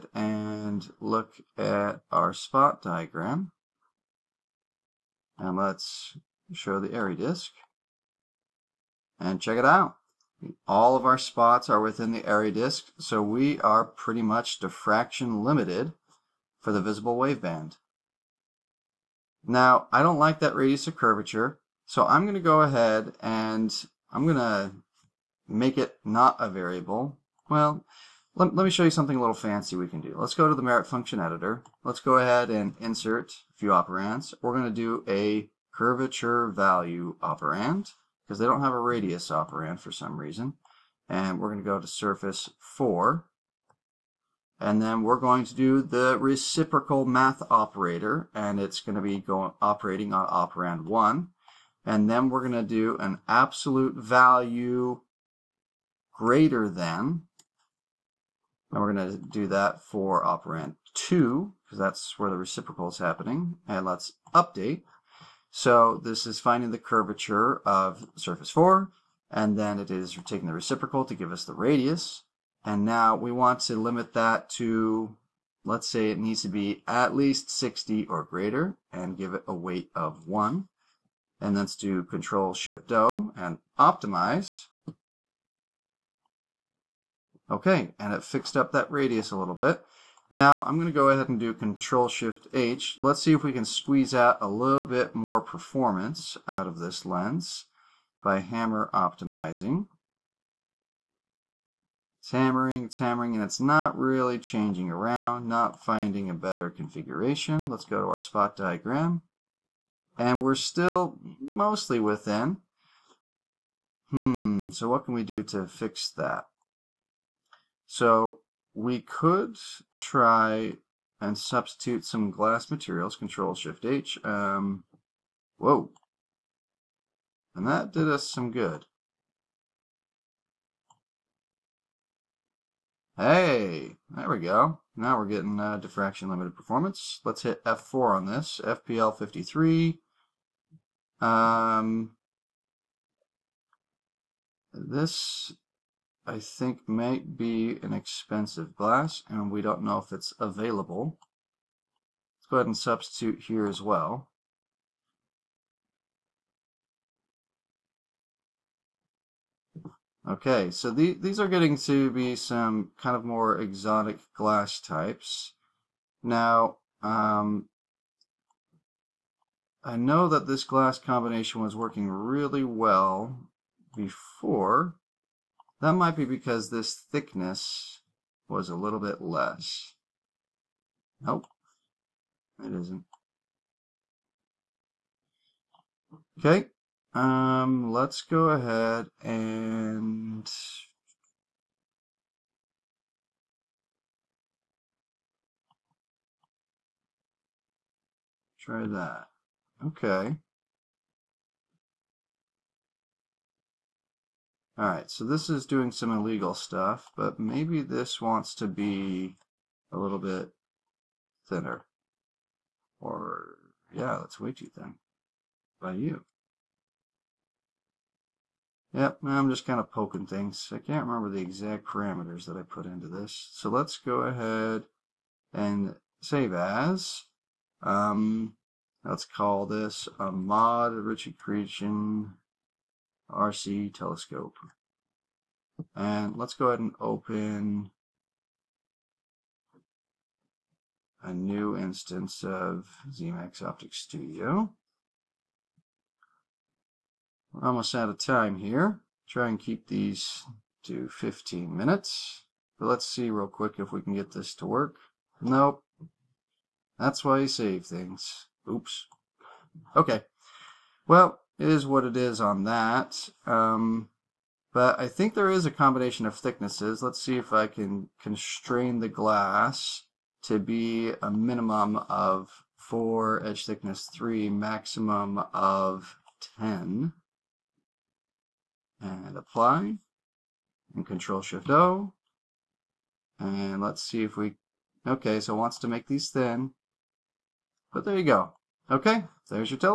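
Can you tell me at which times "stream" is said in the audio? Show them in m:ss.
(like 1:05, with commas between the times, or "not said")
not said.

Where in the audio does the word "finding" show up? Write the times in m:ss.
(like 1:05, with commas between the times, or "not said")
1:06, 1:45.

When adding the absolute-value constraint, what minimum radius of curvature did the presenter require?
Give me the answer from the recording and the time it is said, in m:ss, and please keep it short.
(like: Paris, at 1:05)
60, at 1:17.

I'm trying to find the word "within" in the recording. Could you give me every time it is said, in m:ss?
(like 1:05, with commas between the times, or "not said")
0:11, 1:51.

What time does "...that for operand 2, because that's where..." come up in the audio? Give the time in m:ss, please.
0:59.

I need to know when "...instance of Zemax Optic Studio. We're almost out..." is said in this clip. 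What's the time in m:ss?
4:01.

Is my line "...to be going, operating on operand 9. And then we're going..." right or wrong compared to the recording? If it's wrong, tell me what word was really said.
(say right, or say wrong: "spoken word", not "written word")
wrong: "1", not "9".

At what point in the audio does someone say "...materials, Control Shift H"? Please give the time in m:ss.
2:02.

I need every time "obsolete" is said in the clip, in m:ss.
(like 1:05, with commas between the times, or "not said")
not said.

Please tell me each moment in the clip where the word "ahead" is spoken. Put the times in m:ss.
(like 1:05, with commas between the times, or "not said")
0:22, 0:32, 1:31, 2:32, 3:08, 3:44, 3:56.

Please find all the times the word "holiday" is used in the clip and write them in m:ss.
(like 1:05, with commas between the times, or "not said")
not said.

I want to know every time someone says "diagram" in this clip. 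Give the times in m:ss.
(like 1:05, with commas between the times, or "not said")
0:02, 1:48.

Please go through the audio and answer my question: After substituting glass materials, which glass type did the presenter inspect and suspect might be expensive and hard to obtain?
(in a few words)
FPL 53.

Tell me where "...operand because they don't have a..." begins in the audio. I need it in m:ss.
0:37.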